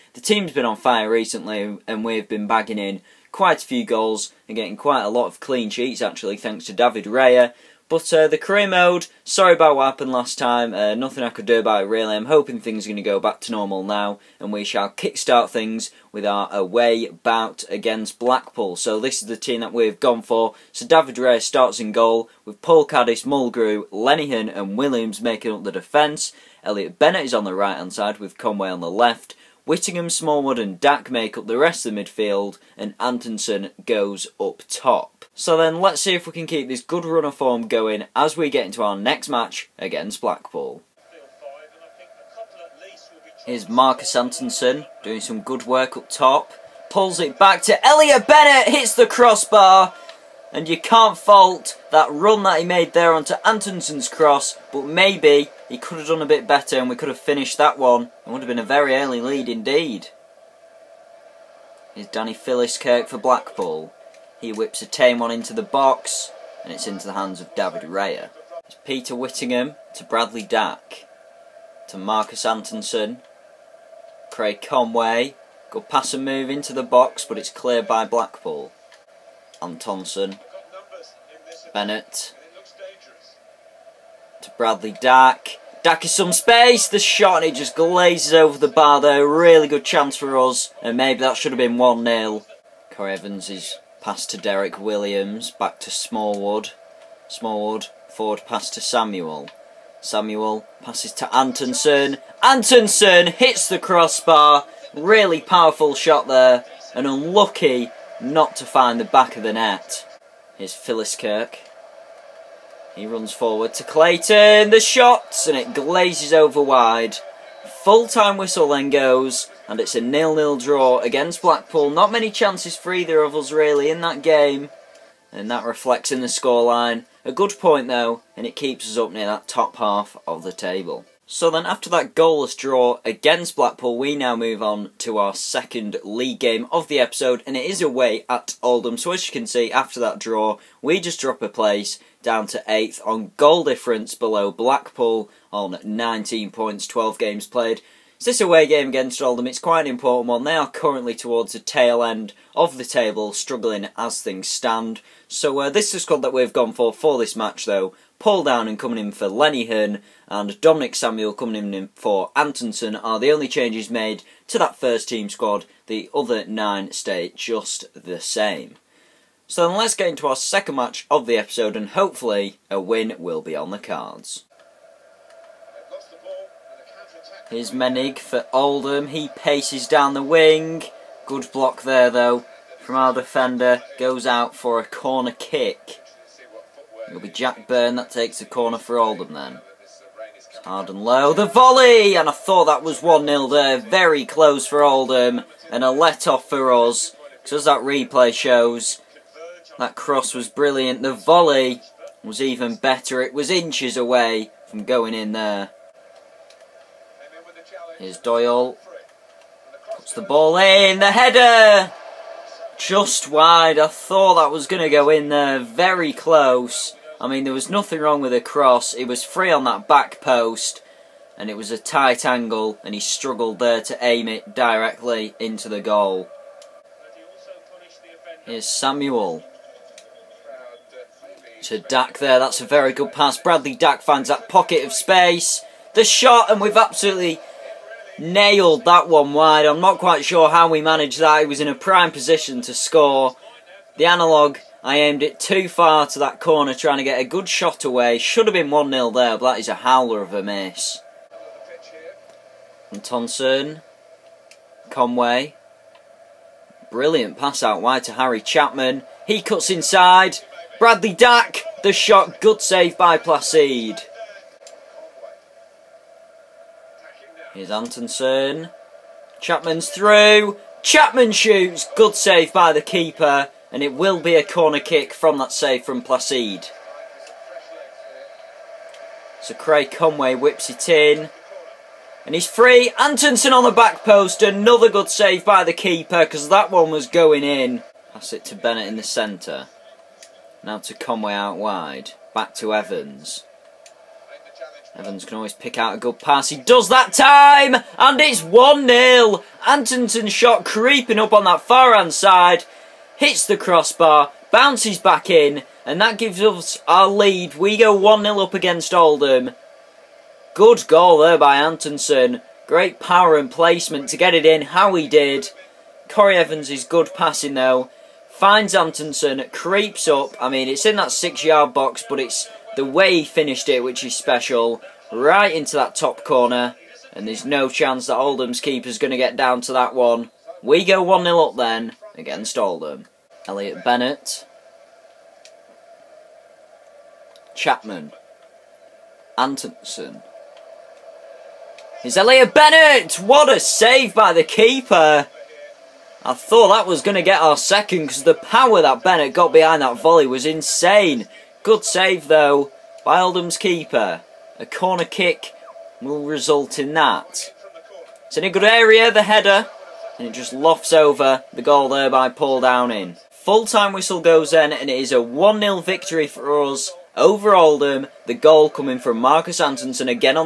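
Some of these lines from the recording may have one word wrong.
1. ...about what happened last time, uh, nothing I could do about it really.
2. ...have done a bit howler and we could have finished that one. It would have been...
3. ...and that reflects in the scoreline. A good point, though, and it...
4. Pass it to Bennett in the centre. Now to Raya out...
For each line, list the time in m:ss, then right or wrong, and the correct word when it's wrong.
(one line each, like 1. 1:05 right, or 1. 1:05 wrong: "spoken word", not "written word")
1. 0:09 right
2. 0:55 wrong: "better", not "howler"
3. 2:05 right
4. 4:48 wrong: "Conway", not "Raya".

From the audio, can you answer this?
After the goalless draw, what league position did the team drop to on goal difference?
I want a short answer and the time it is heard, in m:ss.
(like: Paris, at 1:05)
8th, at 2:22.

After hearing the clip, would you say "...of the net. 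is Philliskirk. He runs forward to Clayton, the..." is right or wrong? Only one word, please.
right.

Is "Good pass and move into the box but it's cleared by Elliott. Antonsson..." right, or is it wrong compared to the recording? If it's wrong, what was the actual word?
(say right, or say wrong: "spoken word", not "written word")
wrong: "Blackpool", not "Elliott".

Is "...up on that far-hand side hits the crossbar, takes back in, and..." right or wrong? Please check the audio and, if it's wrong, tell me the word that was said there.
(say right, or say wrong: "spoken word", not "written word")
wrong: "bounces", not "takes".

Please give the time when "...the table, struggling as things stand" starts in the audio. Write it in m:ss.
2:32.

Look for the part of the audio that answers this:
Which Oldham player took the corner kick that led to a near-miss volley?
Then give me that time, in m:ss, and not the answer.
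3:07.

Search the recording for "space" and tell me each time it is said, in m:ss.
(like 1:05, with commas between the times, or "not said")
1:26, 3:54.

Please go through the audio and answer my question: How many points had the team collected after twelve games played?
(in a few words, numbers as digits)
19.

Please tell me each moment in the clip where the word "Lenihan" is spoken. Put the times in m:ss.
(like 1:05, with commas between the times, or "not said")
0:23, 2:39.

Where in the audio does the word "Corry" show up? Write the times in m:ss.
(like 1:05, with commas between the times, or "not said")
1:32, 5:16.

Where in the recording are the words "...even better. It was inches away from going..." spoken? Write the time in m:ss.
3:22.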